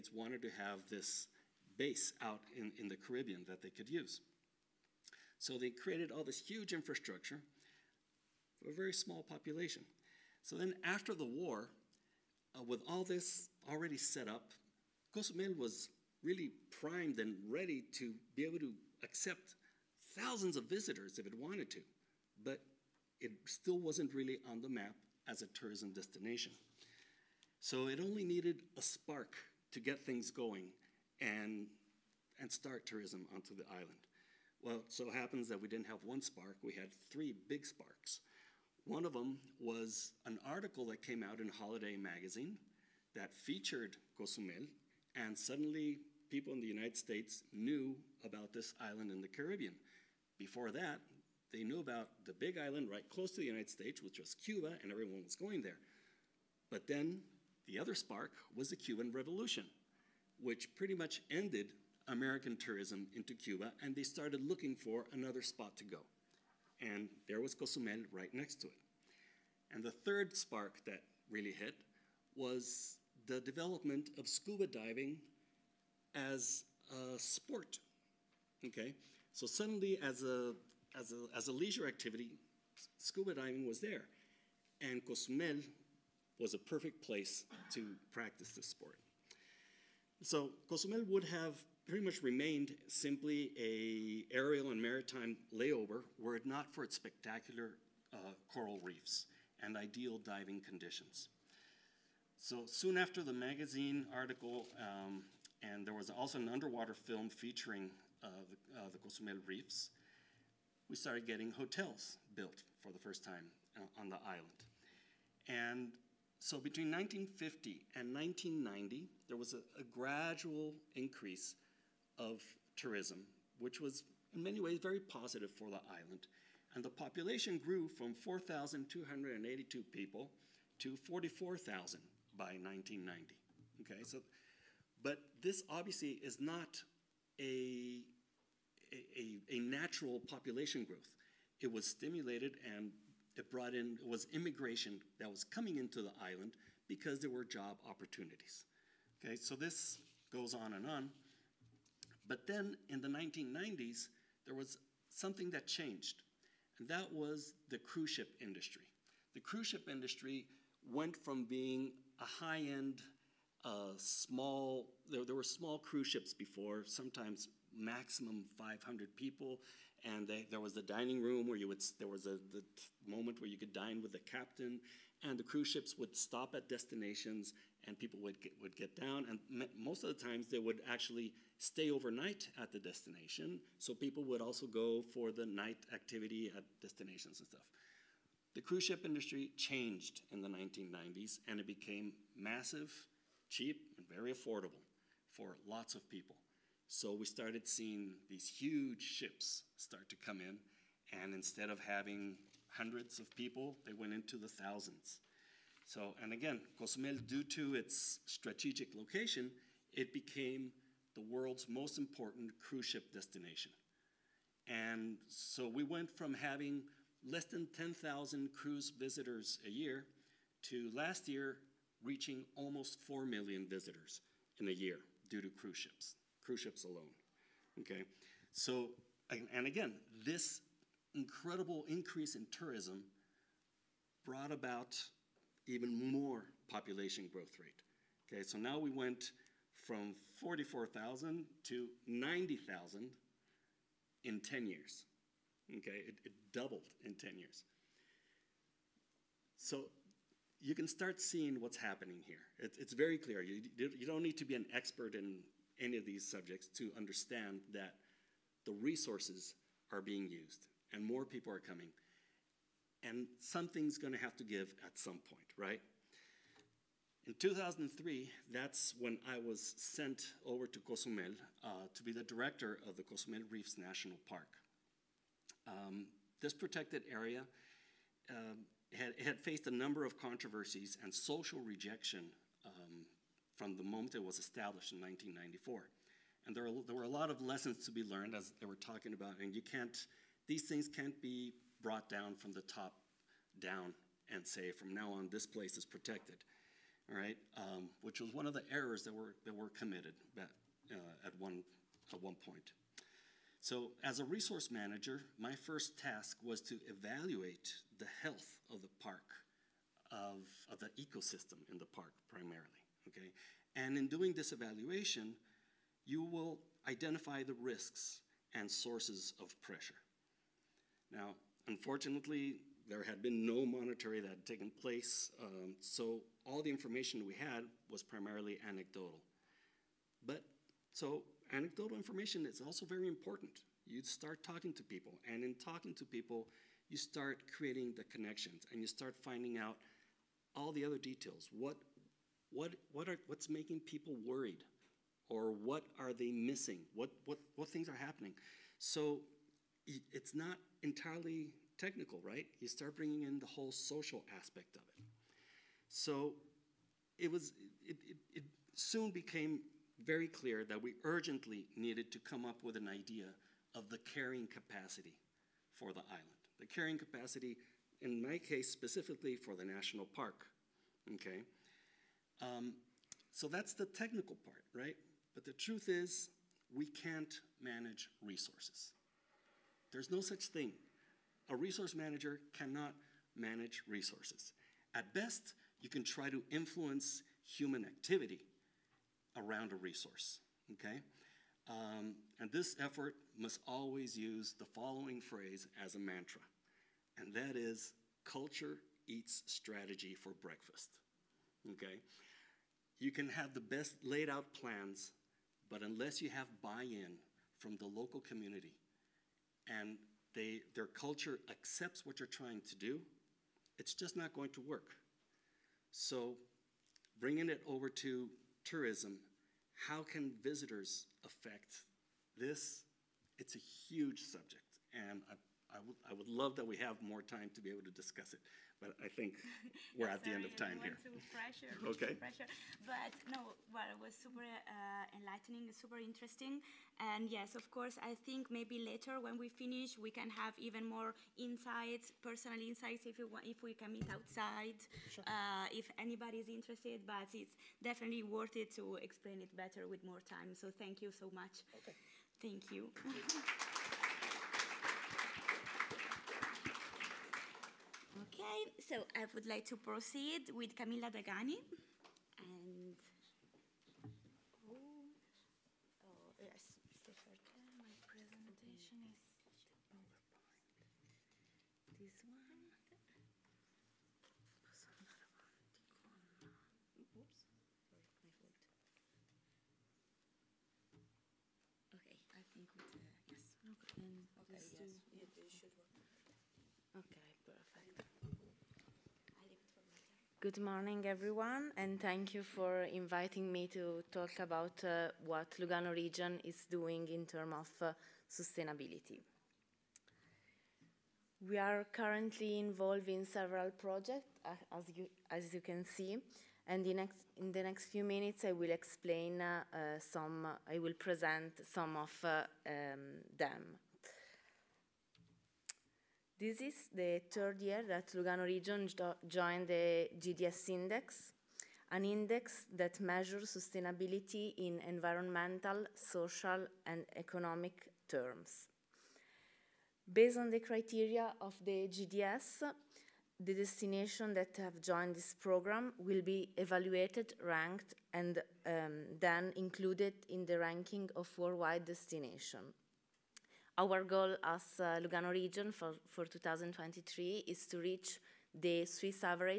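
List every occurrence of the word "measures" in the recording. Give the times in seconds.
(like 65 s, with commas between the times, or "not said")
522 s.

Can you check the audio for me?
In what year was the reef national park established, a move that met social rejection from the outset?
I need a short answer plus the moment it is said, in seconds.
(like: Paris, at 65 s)
1994, at 285 s.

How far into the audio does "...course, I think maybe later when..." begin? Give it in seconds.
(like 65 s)
437 s.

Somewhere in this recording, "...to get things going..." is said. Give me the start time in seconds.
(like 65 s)
29 s.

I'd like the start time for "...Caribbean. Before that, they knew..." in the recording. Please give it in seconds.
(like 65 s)
49 s.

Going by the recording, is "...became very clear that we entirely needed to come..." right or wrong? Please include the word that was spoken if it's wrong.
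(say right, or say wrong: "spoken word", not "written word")
wrong: "urgently", not "entirely".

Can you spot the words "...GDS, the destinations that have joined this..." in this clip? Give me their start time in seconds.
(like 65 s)
531 s.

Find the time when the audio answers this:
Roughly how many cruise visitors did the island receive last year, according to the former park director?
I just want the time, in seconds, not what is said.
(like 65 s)
222 s.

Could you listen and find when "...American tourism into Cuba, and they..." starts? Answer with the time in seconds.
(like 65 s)
62 s.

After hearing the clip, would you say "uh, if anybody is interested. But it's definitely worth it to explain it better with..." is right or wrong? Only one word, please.
right.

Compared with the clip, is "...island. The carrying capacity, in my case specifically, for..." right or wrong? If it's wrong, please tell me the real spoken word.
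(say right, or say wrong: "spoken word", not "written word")
right.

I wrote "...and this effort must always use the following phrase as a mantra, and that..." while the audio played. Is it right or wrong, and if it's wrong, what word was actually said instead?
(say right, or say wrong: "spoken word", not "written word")
right.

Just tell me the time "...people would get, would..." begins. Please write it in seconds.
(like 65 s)
177 s.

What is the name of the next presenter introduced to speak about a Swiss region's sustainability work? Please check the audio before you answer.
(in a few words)
Camilla Dagani.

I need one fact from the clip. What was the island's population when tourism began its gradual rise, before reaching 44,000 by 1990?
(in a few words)
4,282.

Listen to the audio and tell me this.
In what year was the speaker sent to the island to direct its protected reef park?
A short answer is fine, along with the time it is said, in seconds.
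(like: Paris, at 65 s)
2003, at 267 s.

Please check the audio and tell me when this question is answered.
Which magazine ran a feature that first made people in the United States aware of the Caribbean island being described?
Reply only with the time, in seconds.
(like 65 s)
41 s.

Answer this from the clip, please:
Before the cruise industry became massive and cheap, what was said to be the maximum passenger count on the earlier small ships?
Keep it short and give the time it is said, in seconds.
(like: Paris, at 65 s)
500, at 168 s.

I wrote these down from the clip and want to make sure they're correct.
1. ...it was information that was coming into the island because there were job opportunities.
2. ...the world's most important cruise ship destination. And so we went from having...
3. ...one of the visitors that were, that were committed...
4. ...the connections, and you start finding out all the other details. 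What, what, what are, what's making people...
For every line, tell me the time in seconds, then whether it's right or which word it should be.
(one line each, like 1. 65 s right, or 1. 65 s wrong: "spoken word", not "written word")
1. 144 s wrong: "immigration", not "information"
2. 211 s right
3. 298 s wrong: "errors", not "visitors"
4. 337 s right.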